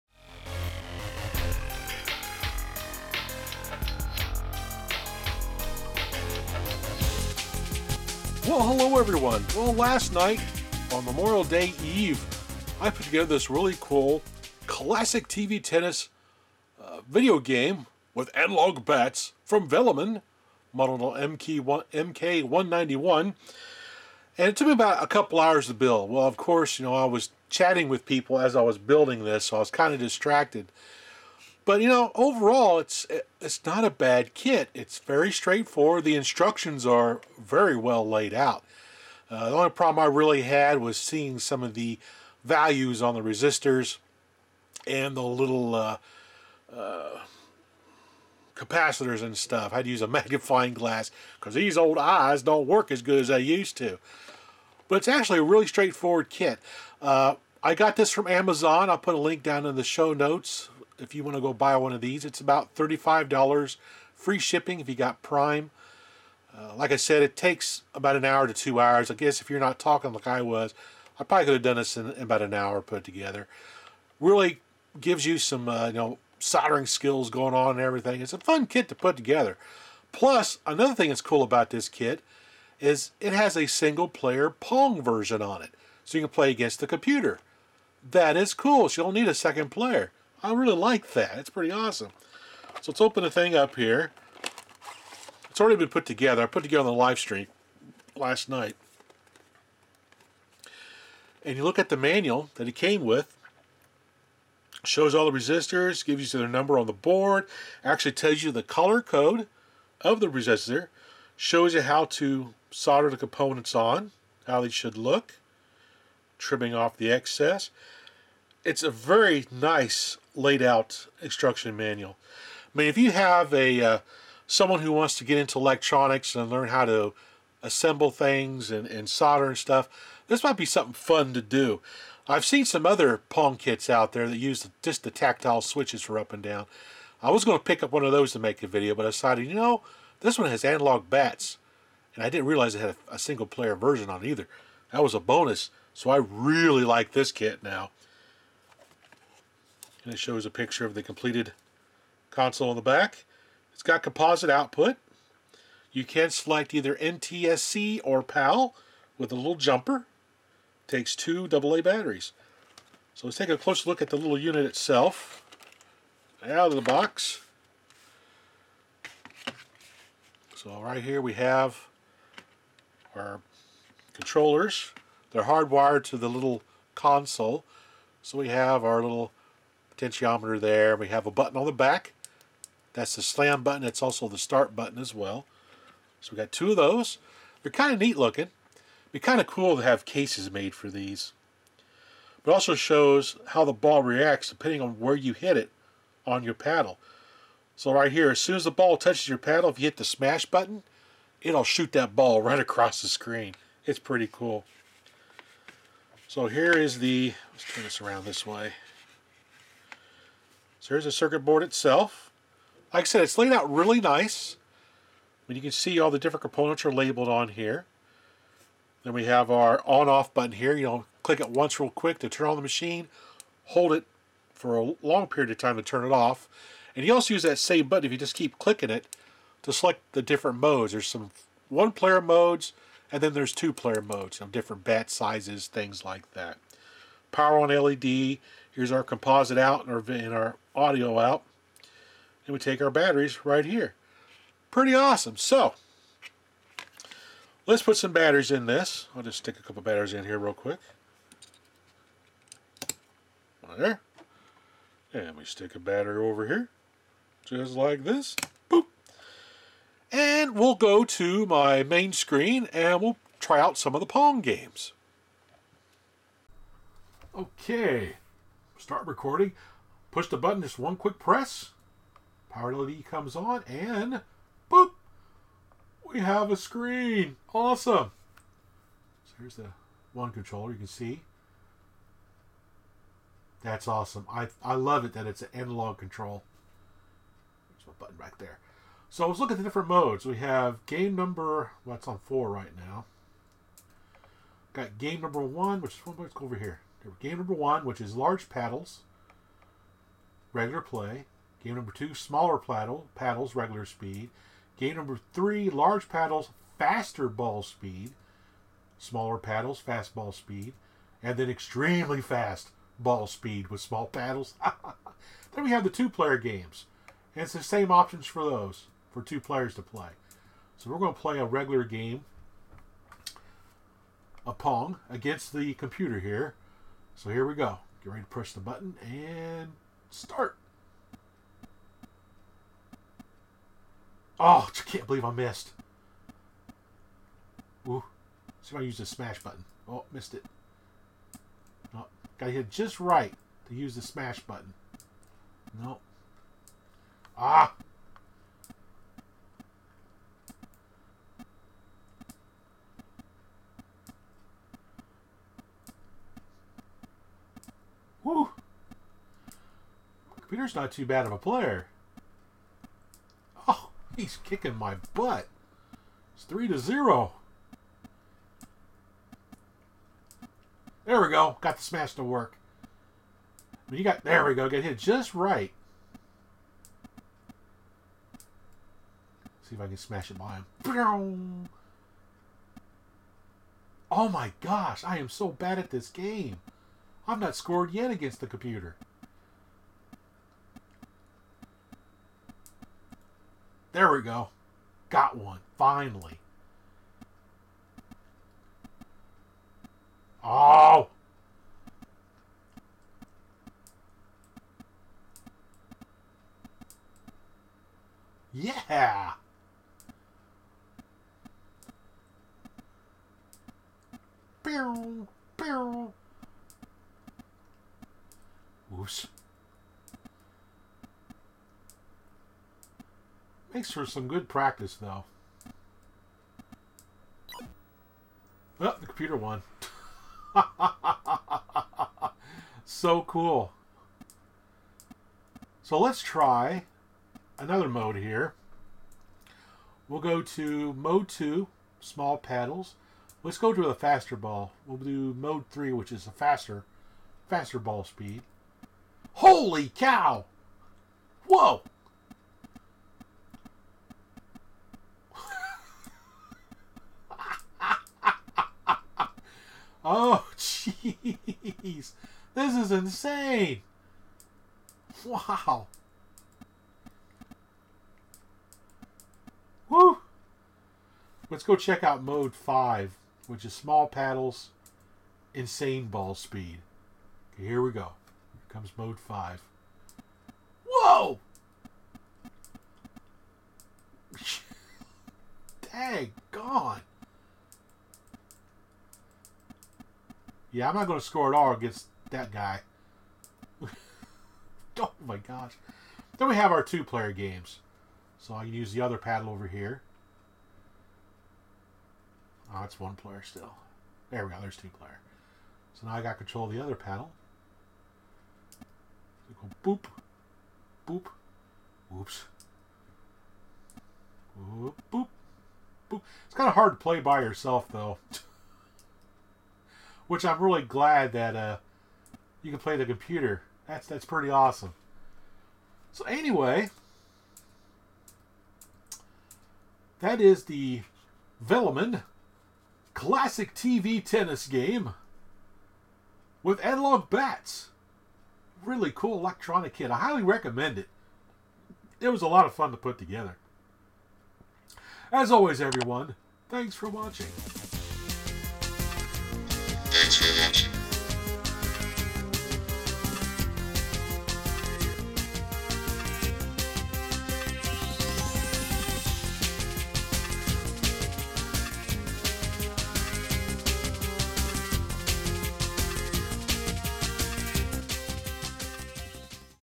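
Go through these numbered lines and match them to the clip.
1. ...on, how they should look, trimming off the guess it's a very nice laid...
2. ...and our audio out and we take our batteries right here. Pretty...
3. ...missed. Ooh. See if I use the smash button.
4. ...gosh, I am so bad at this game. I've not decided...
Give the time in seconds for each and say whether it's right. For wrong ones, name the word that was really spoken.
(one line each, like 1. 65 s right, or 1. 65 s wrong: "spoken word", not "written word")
1. 113 s wrong: "excess", not "guess"
2. 240 s right
3. 335 s right
4. 384 s wrong: "scored", not "decided".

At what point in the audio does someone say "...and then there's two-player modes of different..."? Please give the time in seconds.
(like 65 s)
233 s.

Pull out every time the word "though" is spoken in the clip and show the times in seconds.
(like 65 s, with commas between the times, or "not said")
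424 s, 517 s.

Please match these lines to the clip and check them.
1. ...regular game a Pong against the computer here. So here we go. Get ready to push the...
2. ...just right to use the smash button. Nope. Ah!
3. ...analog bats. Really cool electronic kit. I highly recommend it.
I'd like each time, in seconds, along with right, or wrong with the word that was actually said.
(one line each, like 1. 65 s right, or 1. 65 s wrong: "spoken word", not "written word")
1. 321 s right
2. 342 s right
3. 536 s right.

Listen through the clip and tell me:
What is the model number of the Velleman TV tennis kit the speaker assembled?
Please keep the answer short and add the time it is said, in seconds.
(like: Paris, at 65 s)
MK191, at 21 s.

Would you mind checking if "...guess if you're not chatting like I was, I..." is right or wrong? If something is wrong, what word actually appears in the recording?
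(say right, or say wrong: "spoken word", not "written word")
wrong: "talking", not "chatting".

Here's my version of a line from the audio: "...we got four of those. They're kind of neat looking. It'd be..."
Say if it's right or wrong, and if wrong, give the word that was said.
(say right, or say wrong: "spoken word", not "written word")
wrong: "two", not "four".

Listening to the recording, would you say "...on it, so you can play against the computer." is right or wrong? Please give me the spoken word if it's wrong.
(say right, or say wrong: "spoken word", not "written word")
right.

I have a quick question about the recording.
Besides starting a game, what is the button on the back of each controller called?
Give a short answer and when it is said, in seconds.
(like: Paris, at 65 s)
Slam button, at 183 s.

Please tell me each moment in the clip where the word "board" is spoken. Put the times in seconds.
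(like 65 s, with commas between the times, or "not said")
106 s, 211 s.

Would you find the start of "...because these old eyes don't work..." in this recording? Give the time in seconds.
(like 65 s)
51 s.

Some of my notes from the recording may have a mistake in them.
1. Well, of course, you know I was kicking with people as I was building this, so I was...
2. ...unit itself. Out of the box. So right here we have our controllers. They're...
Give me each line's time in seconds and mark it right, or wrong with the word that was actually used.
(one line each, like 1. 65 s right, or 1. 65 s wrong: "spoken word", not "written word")
1. 26 s wrong: "chatting", not "kicking"
2. 164 s right.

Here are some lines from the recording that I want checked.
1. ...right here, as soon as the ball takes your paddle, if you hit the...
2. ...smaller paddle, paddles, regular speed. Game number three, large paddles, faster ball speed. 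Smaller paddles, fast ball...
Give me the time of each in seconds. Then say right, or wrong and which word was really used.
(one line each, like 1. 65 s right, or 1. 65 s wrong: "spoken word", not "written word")
1. 197 s wrong: "touches", not "takes"
2. 302 s right.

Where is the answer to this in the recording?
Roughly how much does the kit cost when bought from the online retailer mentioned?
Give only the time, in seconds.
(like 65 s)
62 s.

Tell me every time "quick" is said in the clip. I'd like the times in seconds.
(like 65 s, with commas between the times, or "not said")
221 s, 250 s, 270 s.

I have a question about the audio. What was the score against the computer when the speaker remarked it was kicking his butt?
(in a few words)
3 to 0.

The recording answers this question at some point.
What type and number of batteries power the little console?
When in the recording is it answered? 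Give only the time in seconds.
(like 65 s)
161 s.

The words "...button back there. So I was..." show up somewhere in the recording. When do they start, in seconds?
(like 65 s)
287 s.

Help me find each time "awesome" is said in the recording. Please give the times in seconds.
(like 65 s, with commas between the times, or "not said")
91 s, 244 s, 277 s, 283 s, 524 s.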